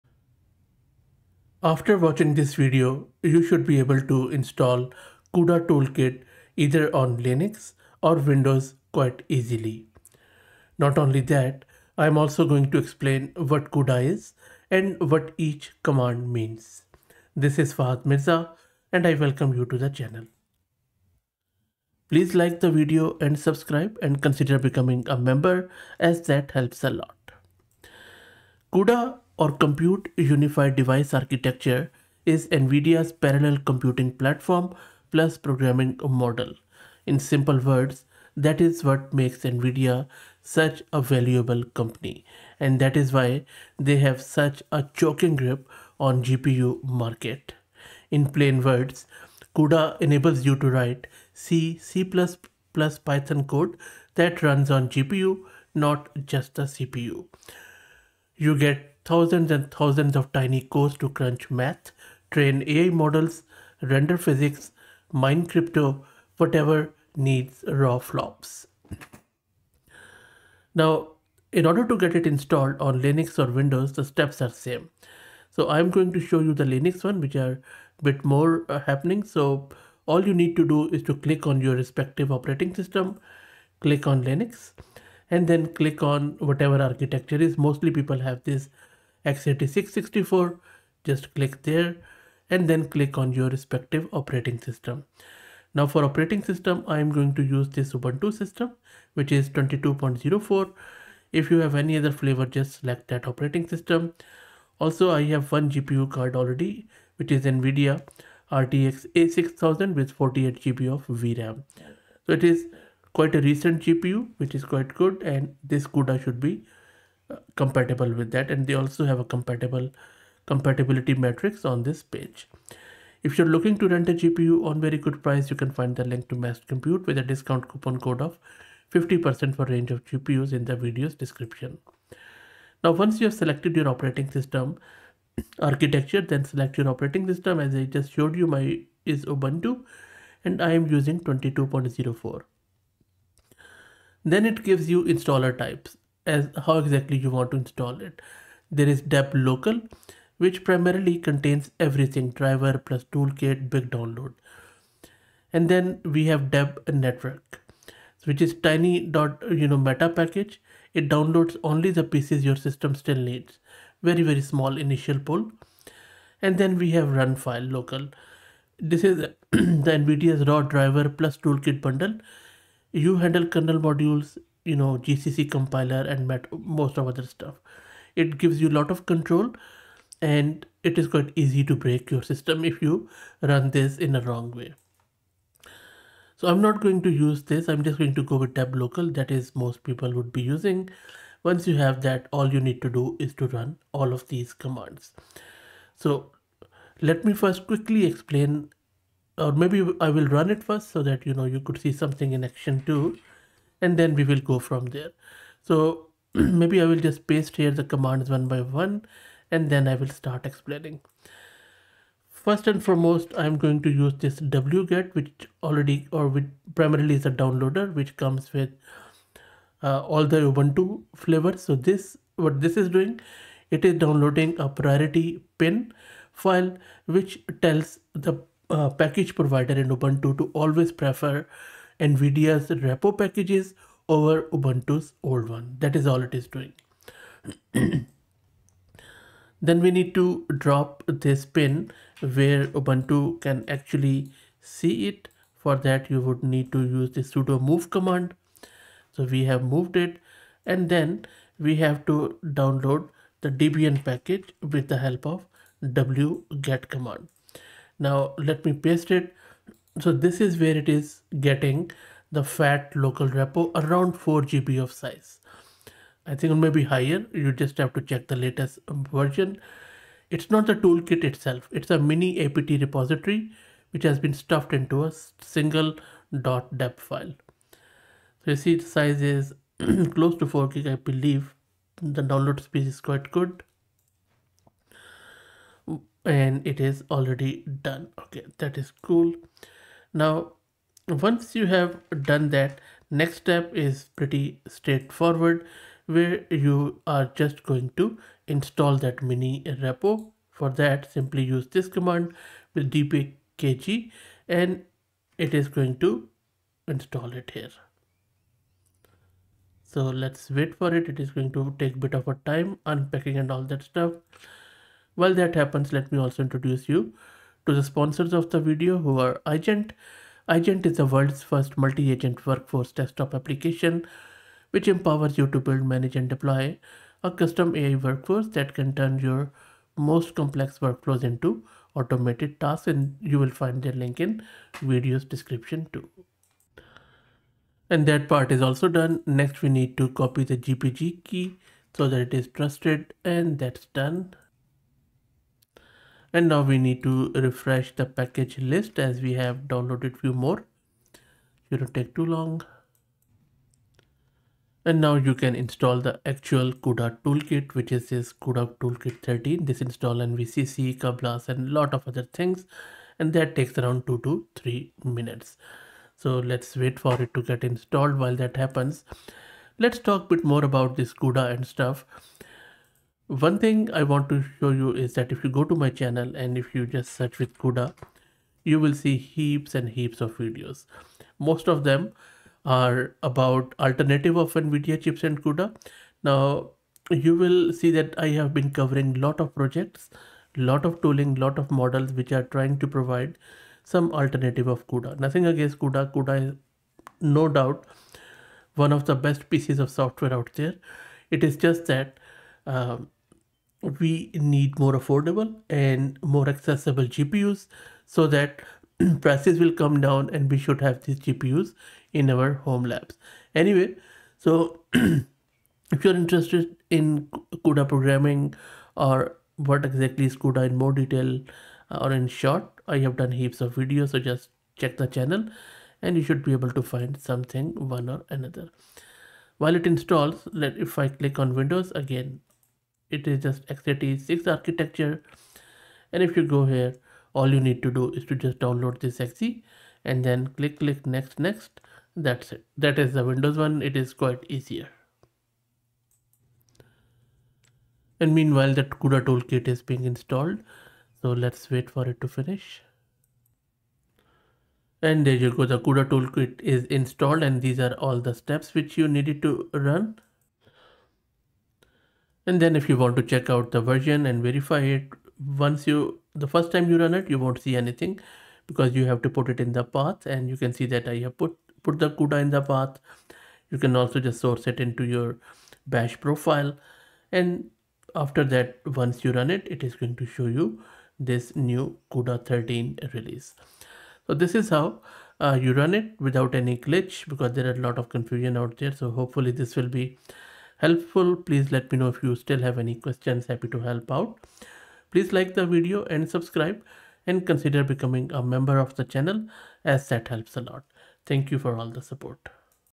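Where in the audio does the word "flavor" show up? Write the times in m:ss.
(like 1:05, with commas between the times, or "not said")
1:42, 3:41.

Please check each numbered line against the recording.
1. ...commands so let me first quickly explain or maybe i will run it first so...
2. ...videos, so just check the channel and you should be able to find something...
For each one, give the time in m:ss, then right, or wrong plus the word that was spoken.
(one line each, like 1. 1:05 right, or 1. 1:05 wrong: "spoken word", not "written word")
1. 3:14 right
2. 7:03 right.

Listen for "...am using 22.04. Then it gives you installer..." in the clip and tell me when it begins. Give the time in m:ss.
2:20.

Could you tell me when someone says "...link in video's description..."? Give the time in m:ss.
5:33.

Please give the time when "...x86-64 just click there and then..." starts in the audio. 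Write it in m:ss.
1:29.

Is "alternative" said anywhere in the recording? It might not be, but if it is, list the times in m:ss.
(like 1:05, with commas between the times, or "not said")
6:23, 6:34.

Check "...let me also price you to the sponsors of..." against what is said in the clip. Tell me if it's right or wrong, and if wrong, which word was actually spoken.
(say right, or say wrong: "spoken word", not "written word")
wrong: "introduce", not "price".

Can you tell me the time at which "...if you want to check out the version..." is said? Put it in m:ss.
7:42.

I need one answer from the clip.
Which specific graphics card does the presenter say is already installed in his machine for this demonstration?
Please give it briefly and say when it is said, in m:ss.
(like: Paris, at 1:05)
NVIDIA RTX A6000, at 1:47.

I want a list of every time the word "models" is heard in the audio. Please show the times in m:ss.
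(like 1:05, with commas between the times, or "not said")
0:36, 1:02, 6:31.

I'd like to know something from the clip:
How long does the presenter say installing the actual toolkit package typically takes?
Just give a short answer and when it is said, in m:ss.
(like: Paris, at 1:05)
2 to 3 minutes, at 6:04.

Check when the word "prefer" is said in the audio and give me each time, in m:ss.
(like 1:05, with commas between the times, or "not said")
3:50.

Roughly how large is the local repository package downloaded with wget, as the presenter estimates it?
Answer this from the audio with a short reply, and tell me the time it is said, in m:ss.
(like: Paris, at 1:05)
4 GB, at 4:24.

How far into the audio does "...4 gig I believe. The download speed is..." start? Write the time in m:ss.
4:40.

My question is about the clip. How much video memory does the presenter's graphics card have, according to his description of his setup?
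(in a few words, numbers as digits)
48 GB.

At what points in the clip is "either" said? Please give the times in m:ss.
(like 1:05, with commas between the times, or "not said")
0:06.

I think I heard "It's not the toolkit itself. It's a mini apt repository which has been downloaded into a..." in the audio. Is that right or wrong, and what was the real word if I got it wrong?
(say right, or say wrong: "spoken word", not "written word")
wrong: "stuffed", not "downloaded".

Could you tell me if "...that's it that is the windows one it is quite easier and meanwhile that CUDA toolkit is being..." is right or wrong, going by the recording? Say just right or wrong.
right.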